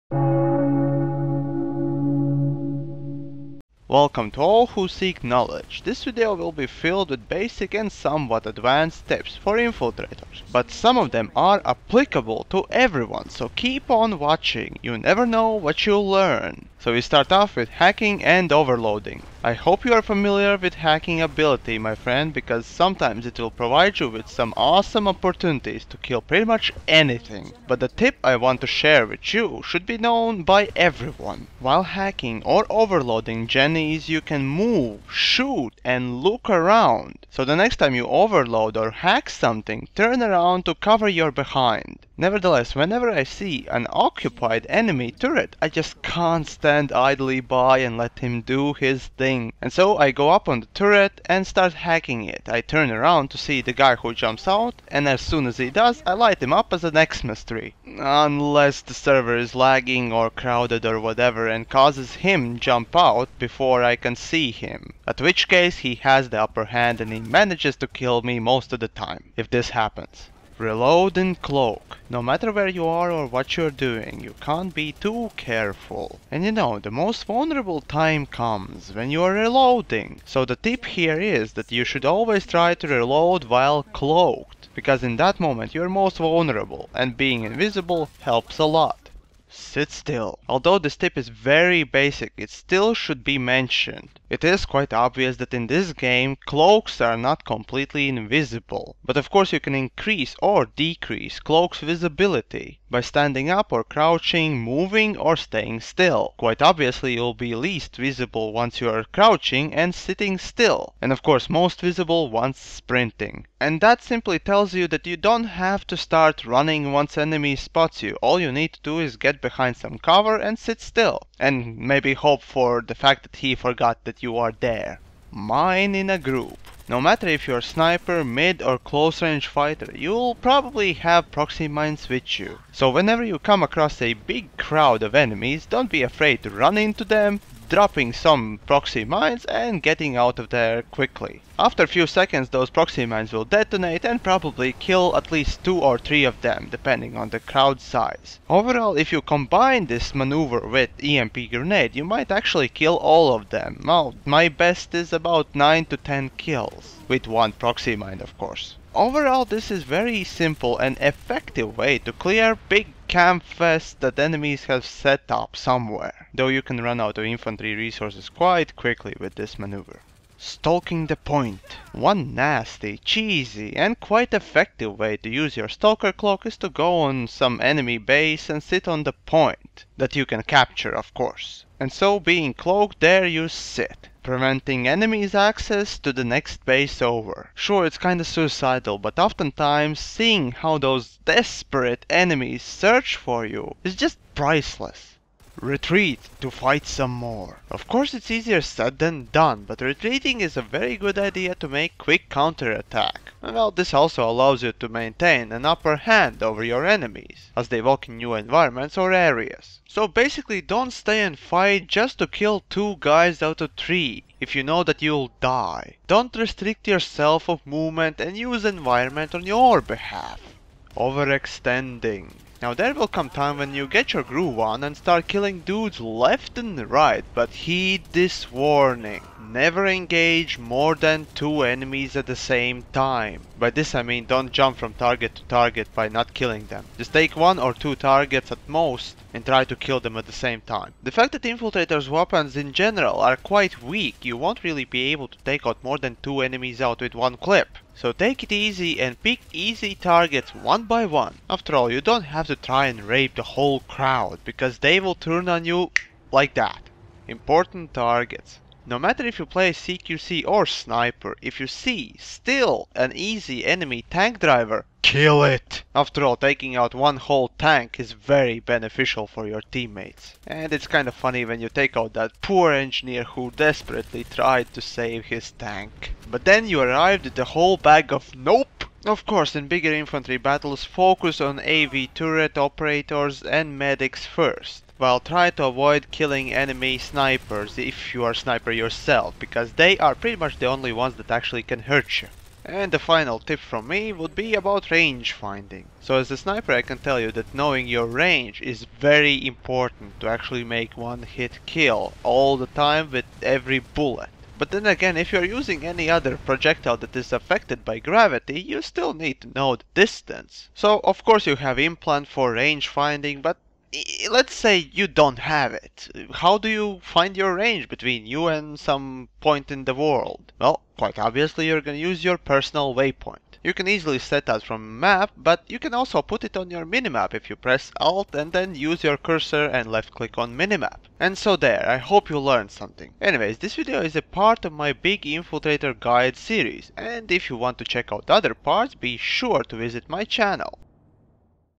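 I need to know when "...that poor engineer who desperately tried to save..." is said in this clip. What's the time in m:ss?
4:32.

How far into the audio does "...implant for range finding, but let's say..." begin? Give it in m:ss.
5:11.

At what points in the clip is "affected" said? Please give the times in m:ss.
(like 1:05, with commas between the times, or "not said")
5:07.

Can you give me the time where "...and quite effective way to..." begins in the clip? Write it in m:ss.
2:53.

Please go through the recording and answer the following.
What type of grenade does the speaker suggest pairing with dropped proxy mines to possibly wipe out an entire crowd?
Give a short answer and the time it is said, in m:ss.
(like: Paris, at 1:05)
EMP grenade, at 2:31.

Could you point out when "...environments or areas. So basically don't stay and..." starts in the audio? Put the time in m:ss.
3:28.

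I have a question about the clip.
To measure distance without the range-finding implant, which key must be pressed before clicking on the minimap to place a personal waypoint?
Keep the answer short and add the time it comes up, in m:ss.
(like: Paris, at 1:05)
Alt, at 5:27.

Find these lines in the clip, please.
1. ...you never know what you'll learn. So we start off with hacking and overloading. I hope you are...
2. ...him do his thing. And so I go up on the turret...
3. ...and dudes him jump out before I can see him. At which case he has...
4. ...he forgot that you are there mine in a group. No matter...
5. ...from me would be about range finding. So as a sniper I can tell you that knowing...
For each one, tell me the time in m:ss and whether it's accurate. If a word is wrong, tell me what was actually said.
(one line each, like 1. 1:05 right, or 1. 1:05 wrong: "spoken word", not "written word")
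1. 0:14 right
2. 0:48 right
3. 1:01 wrong: "causes", not "dudes"
4. 2:03 right
5. 4:53 right.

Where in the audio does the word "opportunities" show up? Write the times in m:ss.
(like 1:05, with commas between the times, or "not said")
0:25.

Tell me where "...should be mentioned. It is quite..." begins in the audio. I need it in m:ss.
1:32.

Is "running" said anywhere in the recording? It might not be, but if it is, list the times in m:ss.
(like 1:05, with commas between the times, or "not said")
1:56.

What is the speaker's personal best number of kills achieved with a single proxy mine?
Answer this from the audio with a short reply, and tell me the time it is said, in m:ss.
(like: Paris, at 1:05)
9 to 10, at 2:35.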